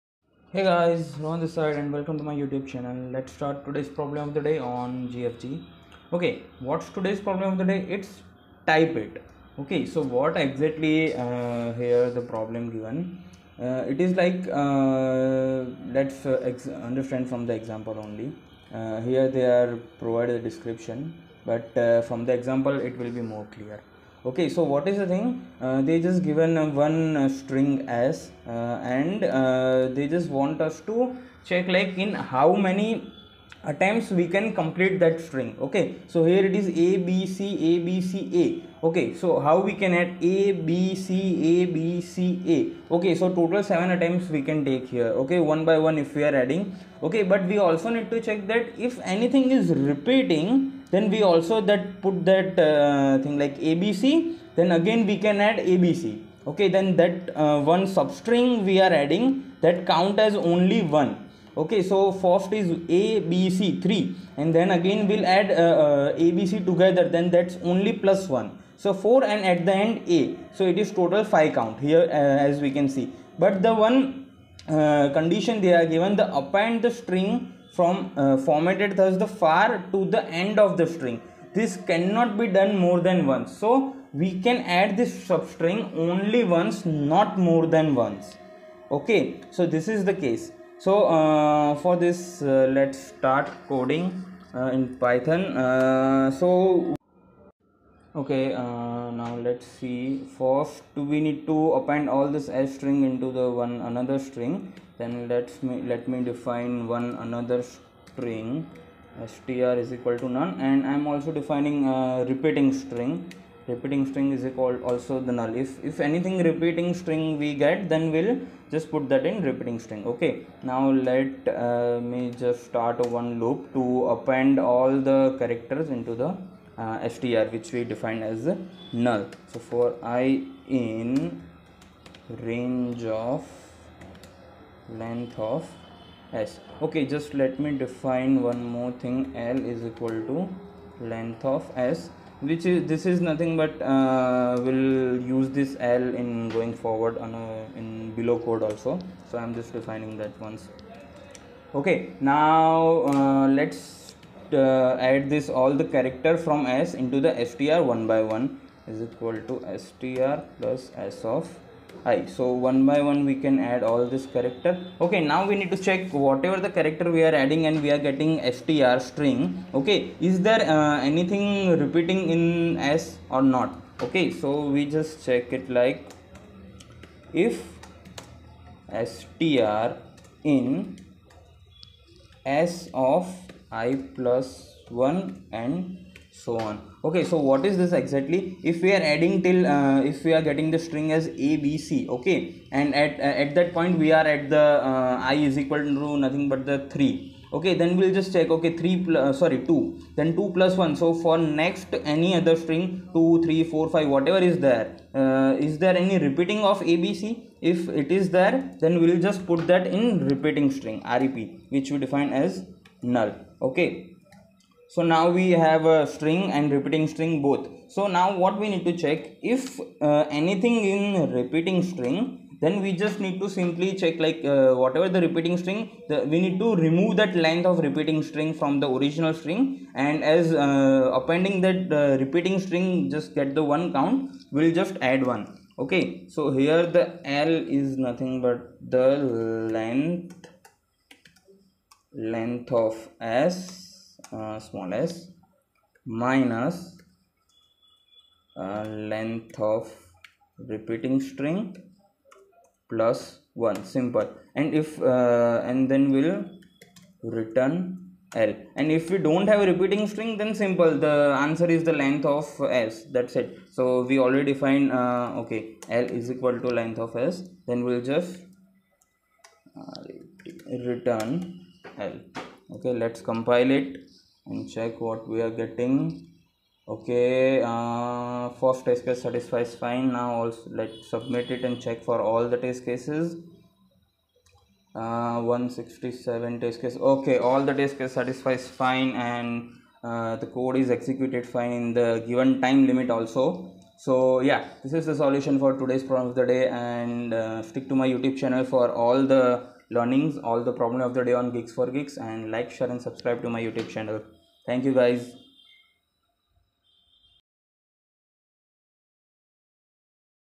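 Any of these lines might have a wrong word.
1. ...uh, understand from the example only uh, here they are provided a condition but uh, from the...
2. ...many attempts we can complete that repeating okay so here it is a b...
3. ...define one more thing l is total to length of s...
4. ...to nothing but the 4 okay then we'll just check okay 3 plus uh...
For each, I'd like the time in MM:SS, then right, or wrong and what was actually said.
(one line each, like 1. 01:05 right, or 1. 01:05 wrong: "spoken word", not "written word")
1. 00:16 wrong: "description", not "condition"
2. 00:32 wrong: "string", not "repeating"
3. 02:17 wrong: "equal", not "total"
4. 03:15 wrong: "3", not "4".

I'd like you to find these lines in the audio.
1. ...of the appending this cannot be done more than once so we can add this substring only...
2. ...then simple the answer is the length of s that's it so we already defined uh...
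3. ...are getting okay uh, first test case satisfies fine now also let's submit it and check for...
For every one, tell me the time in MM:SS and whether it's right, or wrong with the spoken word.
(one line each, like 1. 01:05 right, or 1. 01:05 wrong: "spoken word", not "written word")
1. 01:20 wrong: "string", not "appending"
2. 04:20 right
3. 04:35 right.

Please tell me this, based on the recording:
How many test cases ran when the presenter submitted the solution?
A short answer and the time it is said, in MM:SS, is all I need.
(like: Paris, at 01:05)
167, at 04:45.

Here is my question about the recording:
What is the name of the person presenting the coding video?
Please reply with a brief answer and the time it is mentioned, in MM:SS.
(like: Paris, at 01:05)
Rohan, at 00:01.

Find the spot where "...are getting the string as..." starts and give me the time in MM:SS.
03:10.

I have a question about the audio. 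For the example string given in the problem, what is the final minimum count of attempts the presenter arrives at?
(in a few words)
5.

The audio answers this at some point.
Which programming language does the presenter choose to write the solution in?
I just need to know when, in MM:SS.
01:35.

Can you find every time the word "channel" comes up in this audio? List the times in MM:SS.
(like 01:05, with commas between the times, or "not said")
00:02, 04:58, 05:03.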